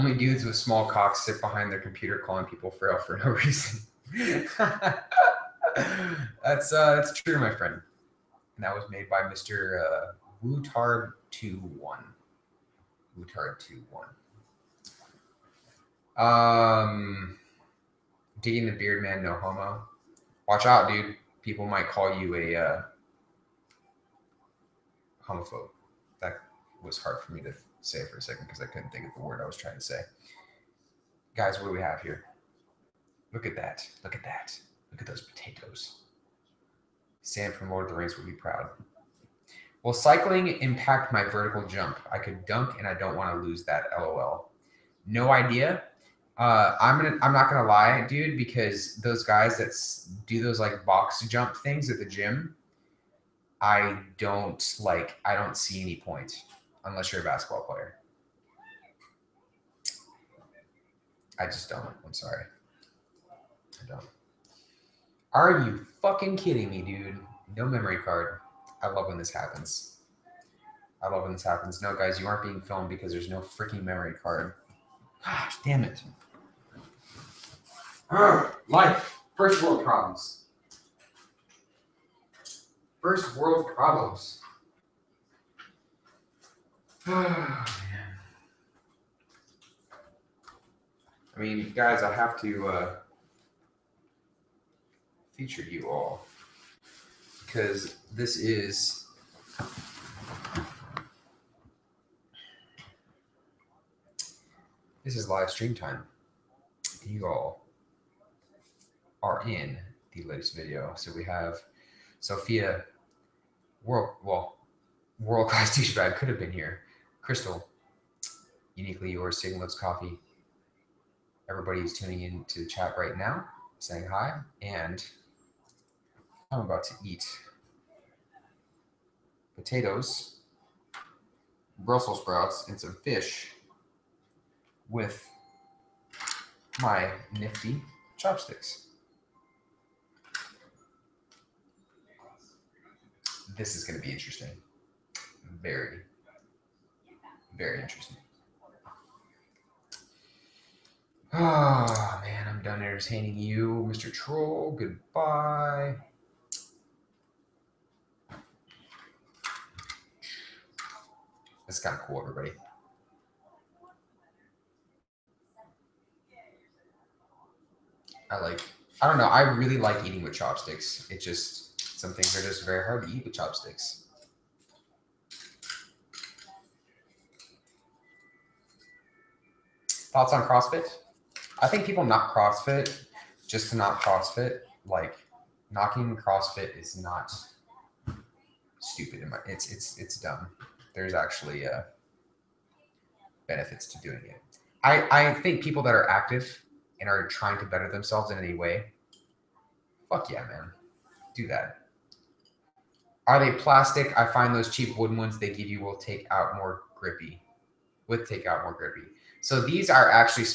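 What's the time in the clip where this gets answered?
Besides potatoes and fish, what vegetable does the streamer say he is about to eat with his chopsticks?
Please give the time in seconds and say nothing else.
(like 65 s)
131 s.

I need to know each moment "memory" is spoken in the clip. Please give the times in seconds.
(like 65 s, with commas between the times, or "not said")
67 s, 73 s.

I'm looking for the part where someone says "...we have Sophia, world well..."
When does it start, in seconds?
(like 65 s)
111 s.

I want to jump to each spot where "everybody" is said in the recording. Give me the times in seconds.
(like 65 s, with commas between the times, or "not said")
121 s, 162 s.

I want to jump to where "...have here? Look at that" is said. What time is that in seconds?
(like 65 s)
31 s.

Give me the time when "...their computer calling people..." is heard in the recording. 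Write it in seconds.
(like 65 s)
1 s.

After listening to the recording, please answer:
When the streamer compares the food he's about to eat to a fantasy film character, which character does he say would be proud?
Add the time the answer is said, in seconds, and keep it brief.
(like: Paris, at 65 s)
Sam, at 37 s.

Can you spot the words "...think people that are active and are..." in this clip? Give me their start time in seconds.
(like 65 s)
195 s.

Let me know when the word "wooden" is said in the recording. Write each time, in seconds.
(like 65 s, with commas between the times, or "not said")
204 s.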